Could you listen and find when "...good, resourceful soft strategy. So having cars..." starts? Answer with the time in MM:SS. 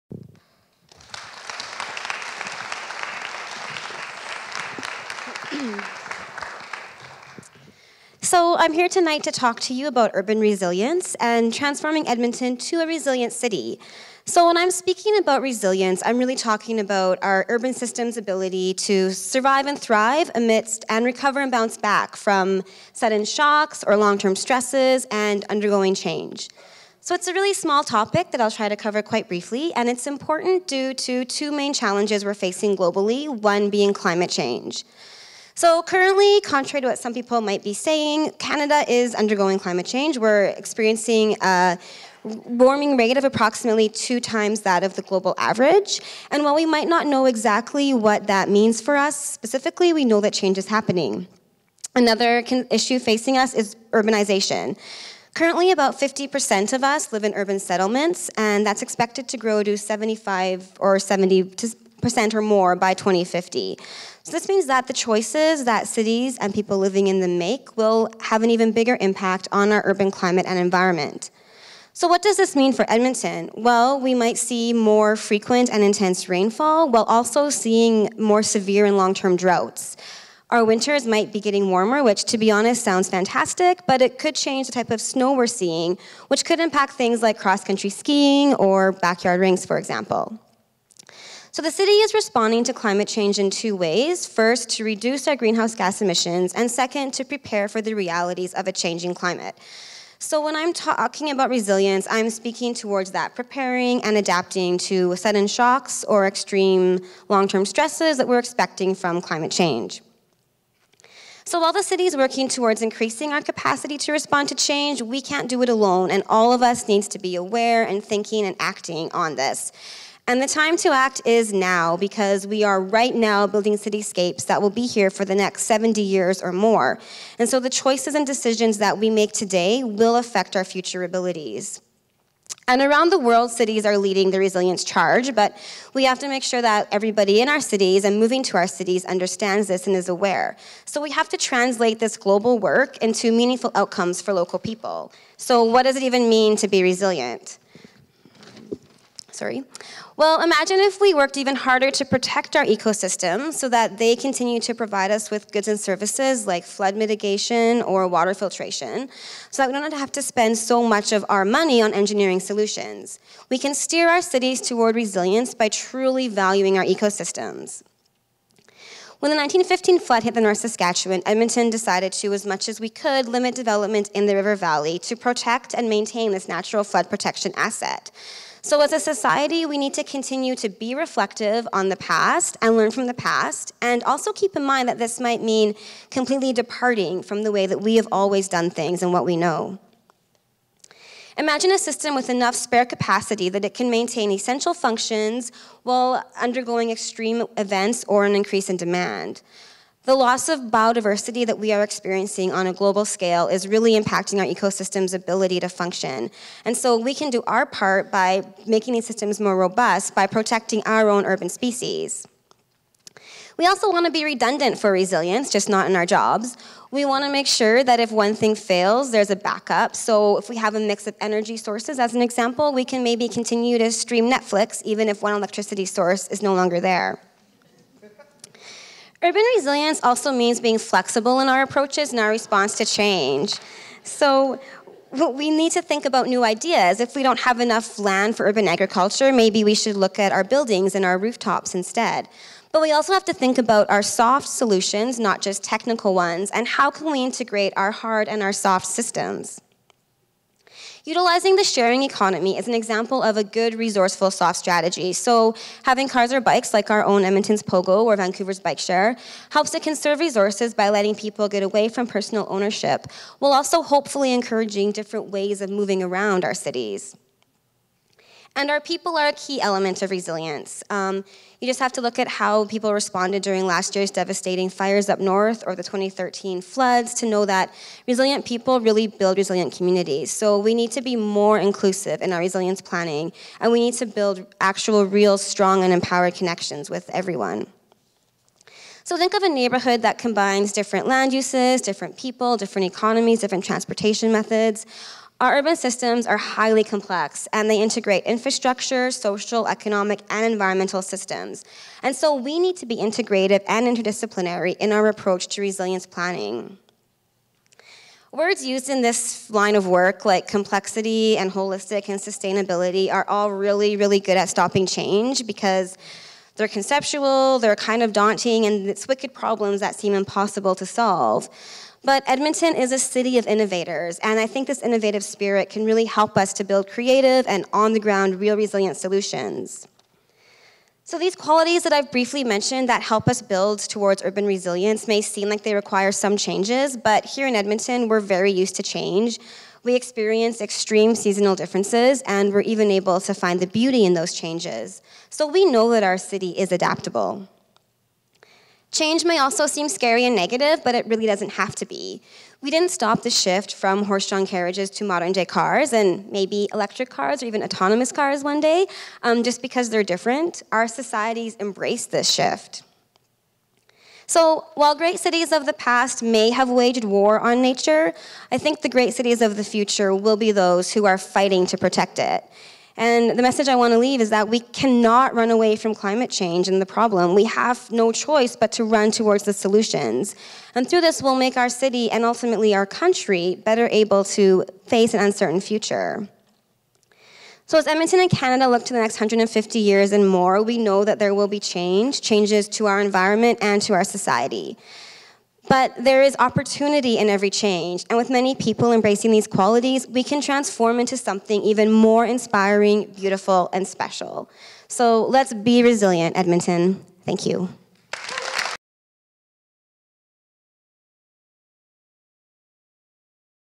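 04:13.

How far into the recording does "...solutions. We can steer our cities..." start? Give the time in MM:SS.
02:42.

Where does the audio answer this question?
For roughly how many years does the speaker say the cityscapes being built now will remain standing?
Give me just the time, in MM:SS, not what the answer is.
02:05.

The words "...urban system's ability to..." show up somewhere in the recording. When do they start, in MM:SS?
00:17.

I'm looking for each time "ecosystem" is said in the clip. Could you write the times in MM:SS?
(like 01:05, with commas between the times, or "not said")
02:32, 02:46, 03:24.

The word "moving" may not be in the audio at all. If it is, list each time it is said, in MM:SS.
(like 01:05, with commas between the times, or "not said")
02:18, 04:25.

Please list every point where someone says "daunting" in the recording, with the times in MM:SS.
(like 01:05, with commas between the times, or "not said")
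05:18.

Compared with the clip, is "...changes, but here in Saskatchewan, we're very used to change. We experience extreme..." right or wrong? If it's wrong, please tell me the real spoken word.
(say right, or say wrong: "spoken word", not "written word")
wrong: "Edmonton", not "Saskatchewan".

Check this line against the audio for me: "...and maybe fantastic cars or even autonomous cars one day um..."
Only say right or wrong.
wrong.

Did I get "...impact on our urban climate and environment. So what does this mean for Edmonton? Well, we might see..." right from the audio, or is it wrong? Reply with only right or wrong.
right.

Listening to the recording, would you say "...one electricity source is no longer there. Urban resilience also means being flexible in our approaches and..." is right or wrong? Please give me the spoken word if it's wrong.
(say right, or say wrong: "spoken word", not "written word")
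right.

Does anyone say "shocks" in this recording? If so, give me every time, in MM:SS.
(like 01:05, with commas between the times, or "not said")
00:23, 01:45.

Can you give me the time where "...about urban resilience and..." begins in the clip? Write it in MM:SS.
00:09.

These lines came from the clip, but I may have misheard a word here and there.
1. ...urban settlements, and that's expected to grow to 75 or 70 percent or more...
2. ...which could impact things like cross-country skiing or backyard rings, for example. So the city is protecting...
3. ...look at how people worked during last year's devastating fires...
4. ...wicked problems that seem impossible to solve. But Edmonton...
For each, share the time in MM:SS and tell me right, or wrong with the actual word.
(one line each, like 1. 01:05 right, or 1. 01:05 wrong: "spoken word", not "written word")
1. 00:57 right
2. 01:26 wrong: "responding", not "protecting"
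3. 04:32 wrong: "responded", not "worked"
4. 05:19 right.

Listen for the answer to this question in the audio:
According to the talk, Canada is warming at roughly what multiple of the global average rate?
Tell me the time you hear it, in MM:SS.
00:43.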